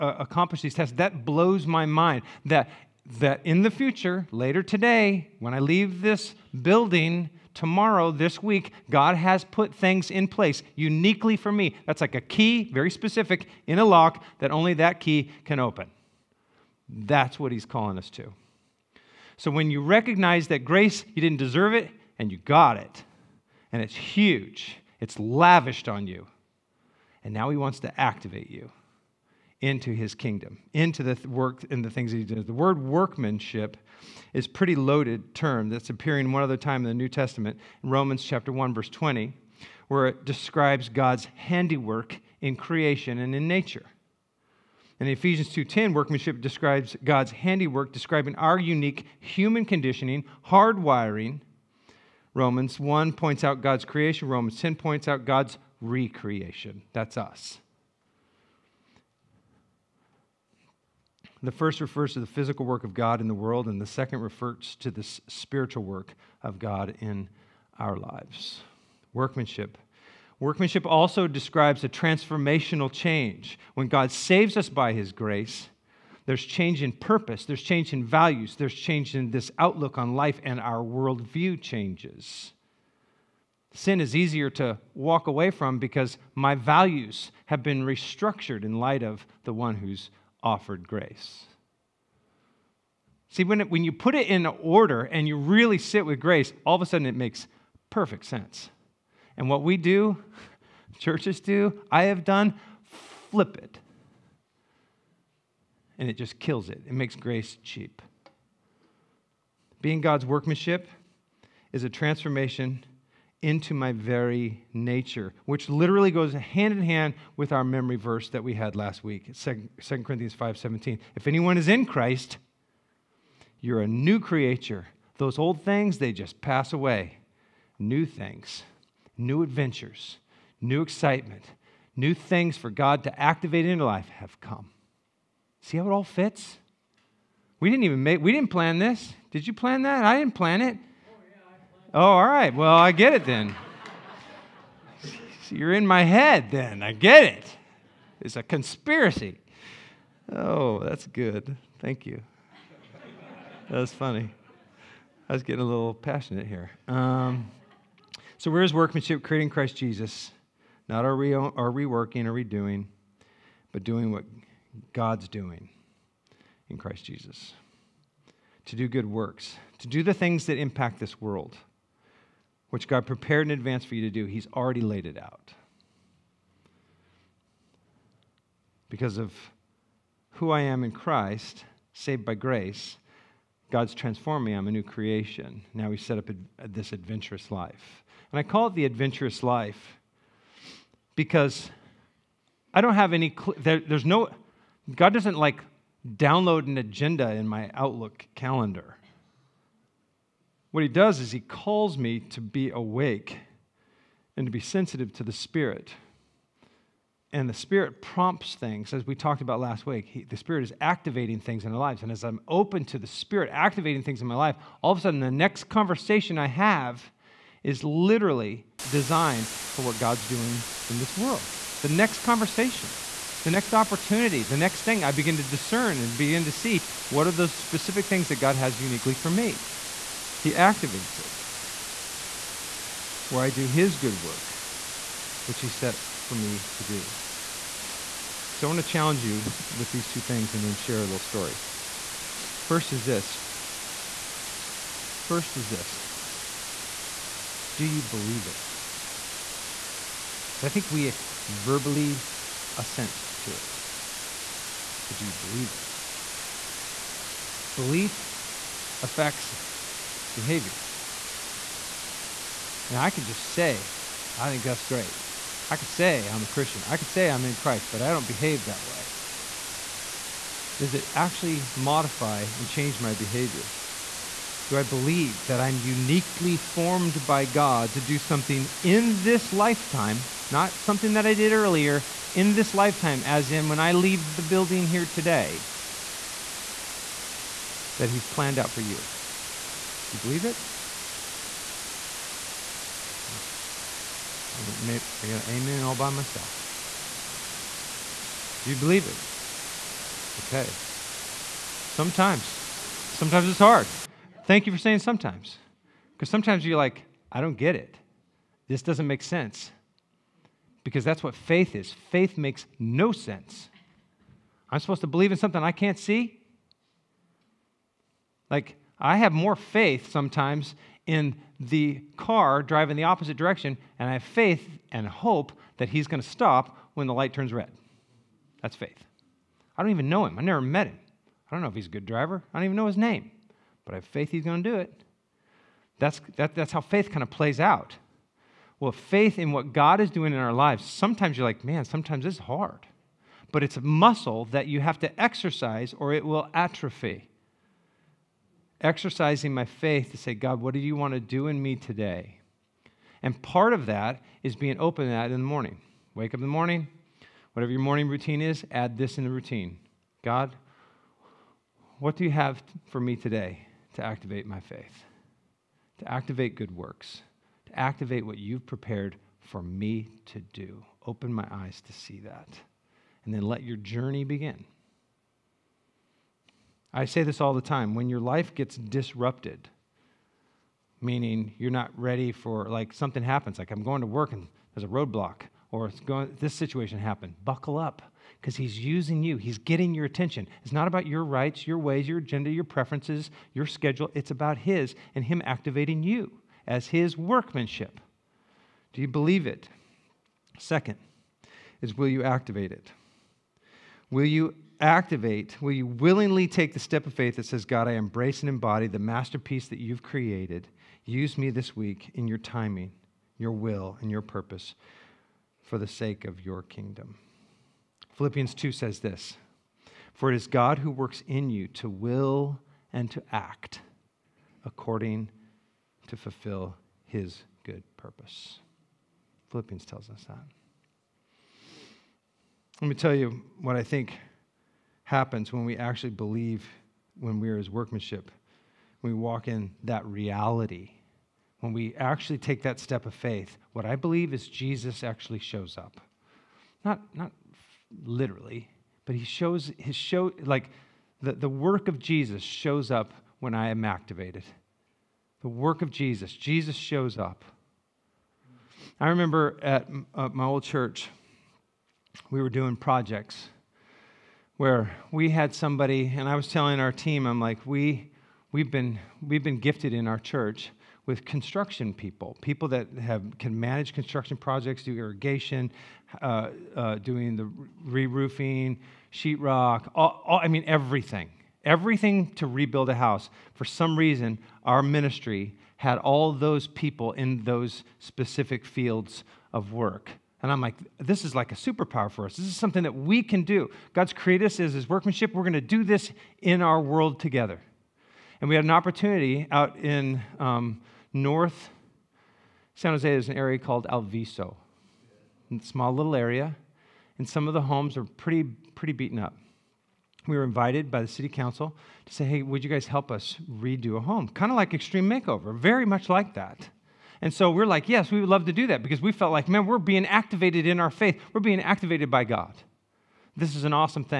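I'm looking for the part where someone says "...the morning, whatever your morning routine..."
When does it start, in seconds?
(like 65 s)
356 s.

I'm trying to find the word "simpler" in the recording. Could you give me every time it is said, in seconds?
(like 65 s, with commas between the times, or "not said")
not said.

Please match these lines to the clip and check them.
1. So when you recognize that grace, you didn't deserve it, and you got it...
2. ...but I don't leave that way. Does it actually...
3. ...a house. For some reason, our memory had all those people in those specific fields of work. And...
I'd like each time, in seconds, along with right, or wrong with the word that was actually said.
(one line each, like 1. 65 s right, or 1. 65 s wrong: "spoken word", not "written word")
1. 19 s right
2. 267 s wrong: "behave", not "leave"
3. 482 s wrong: "ministry", not "memory".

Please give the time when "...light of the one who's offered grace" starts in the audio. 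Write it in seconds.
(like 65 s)
88 s.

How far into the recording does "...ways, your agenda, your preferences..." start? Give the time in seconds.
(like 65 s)
391 s.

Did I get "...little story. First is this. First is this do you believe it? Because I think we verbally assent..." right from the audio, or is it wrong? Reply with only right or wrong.
right.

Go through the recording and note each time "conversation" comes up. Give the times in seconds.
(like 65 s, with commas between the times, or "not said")
215 s, 222 s.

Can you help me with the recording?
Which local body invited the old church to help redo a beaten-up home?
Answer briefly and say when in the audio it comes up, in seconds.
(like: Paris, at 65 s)
city council, at 511 s.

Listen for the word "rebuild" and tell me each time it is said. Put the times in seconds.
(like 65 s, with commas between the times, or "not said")
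482 s.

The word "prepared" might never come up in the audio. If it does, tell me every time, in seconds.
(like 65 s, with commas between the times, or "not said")
173 s, 368 s.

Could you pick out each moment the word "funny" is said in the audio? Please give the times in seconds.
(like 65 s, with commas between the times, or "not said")
153 s.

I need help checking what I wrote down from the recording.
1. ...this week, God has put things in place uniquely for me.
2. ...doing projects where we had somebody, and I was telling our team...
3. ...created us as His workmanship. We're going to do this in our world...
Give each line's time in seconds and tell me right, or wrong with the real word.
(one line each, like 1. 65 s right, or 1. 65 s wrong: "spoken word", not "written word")
1. 8 s right
2. 462 s right
3. 494 s right.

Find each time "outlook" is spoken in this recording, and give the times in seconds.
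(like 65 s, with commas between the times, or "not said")
79 s, 197 s.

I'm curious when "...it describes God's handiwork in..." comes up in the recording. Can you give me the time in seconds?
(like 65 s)
40 s.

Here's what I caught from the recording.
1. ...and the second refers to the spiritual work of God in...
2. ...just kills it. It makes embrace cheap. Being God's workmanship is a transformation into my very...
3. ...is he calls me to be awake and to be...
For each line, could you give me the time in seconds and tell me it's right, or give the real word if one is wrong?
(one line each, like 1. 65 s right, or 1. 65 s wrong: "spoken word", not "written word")
1. 63 s right
2. 106 s wrong: "grace", not "embrace"
3. 201 s right.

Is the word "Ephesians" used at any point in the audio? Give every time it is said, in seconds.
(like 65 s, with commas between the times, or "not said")
45 s.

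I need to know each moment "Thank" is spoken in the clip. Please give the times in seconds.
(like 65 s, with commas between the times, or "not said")
151 s, 304 s.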